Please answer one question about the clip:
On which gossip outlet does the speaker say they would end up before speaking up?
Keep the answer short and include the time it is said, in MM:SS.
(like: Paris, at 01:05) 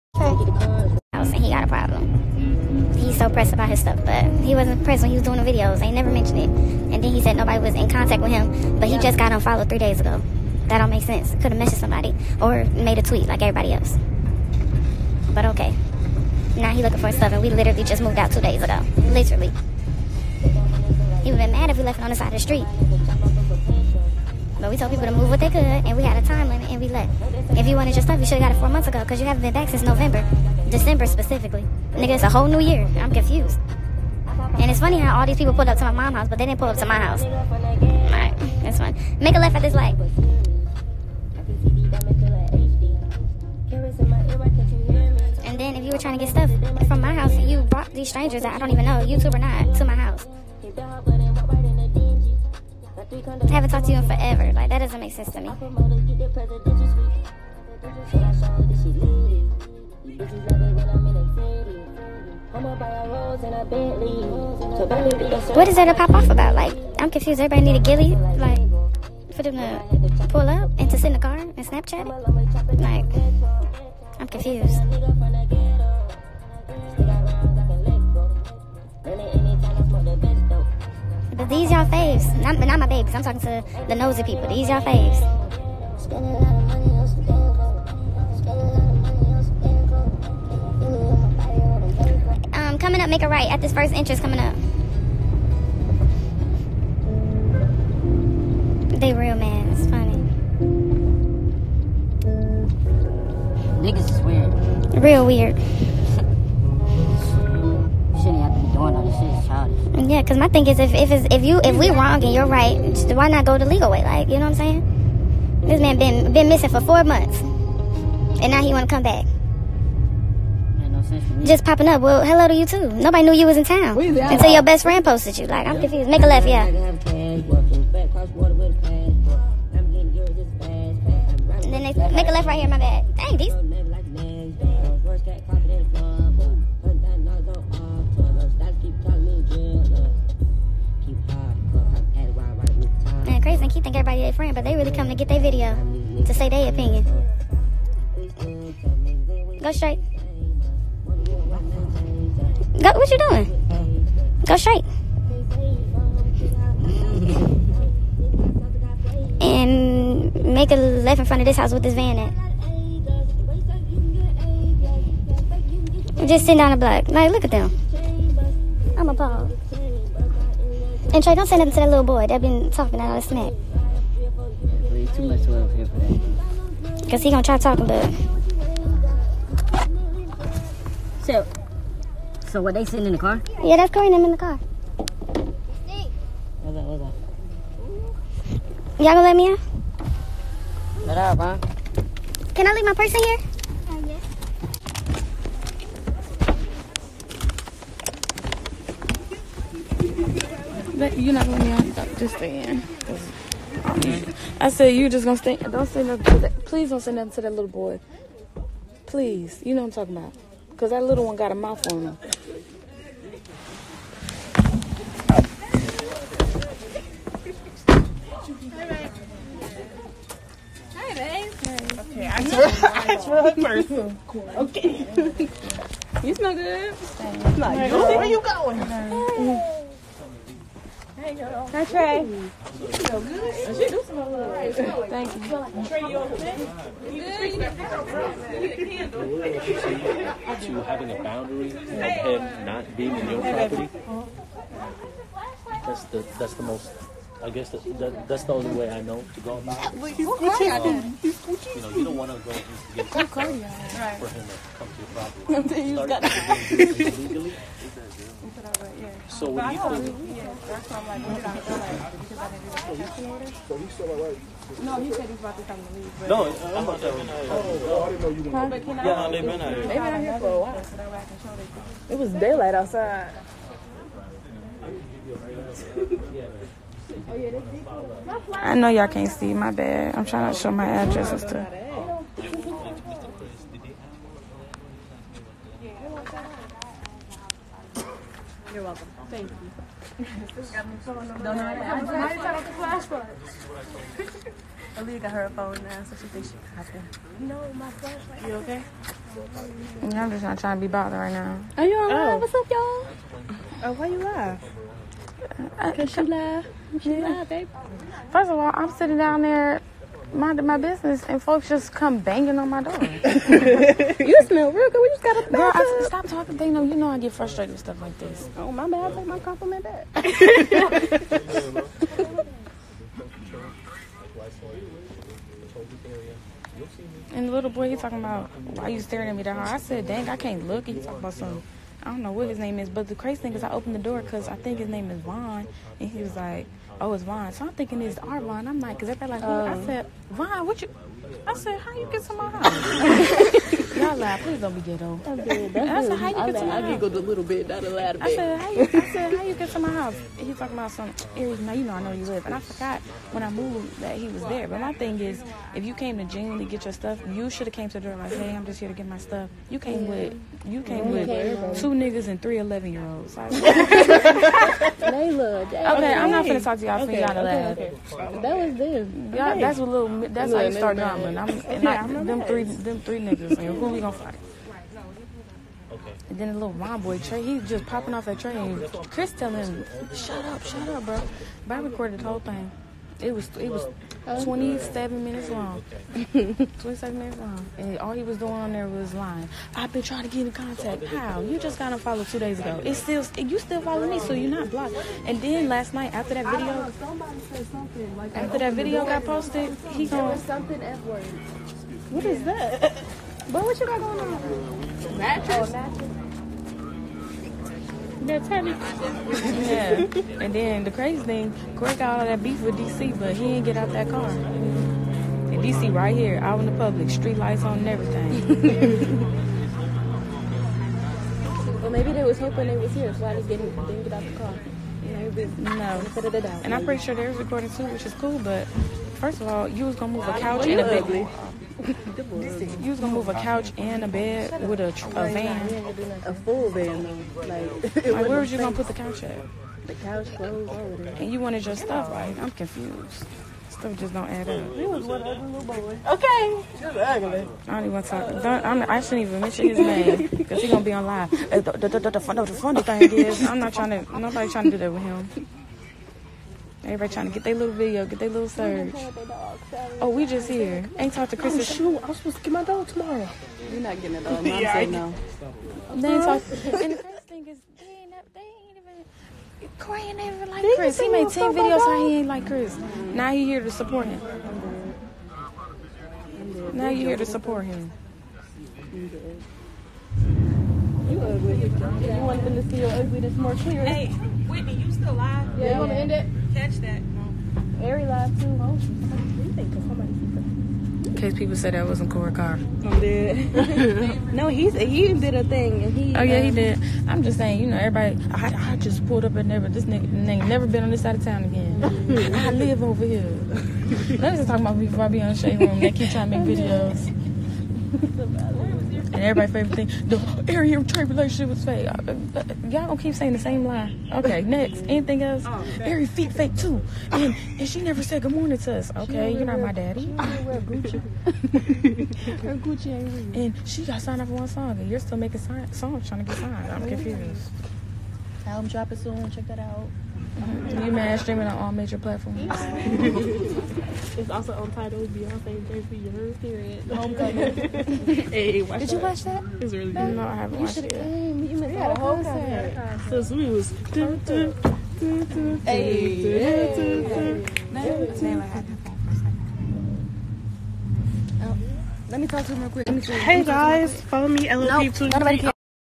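Shade Room, at 08:25.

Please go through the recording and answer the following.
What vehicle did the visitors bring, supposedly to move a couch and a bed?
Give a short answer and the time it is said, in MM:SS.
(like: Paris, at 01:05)
a van, at 07:16.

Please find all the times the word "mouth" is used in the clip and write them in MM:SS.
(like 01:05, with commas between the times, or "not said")
03:31.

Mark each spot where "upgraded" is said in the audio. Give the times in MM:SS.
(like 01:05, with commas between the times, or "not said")
not said.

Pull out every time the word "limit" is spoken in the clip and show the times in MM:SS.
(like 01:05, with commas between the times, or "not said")
00:26.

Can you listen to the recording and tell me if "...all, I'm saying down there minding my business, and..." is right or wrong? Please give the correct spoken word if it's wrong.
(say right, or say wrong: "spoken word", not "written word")
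wrong: "sitting", not "saying".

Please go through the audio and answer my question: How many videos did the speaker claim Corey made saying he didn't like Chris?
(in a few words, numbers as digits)
10.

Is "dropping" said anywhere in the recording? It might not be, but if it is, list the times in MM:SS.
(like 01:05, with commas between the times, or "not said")
08:48.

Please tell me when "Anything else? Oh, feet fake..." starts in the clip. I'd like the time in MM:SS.
08:34.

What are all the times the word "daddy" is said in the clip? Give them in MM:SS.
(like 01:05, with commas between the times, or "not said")
08:39.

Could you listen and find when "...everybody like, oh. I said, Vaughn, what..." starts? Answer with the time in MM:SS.
05:39.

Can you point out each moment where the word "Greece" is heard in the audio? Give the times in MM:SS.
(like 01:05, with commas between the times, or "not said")
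not said.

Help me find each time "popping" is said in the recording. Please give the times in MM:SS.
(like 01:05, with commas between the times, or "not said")
02:01, 06:17.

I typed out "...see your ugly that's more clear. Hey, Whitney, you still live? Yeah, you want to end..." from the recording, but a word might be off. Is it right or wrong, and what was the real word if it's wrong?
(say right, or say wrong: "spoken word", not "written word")
right.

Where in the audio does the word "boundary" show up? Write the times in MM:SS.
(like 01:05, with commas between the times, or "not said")
04:01.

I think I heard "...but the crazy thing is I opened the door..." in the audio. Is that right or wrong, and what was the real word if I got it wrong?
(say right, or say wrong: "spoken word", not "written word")
right.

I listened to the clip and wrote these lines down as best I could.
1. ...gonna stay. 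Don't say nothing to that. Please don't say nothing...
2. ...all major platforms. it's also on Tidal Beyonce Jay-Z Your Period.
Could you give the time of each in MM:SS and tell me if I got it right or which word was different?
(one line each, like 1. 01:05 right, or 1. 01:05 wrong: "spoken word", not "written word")
1. 03:25 right
2. 08:51 right.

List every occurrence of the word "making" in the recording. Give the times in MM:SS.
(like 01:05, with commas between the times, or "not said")
08:45.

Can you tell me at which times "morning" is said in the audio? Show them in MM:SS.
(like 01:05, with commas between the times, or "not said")
08:38.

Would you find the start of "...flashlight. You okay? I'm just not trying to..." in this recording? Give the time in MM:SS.
04:57.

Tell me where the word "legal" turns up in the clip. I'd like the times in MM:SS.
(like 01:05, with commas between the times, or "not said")
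01:53.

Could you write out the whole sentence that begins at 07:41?
Oh, shoot, I was supposed to get my dog tomorrow.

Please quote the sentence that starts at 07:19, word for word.
The couch clothes And you wanted your stuff.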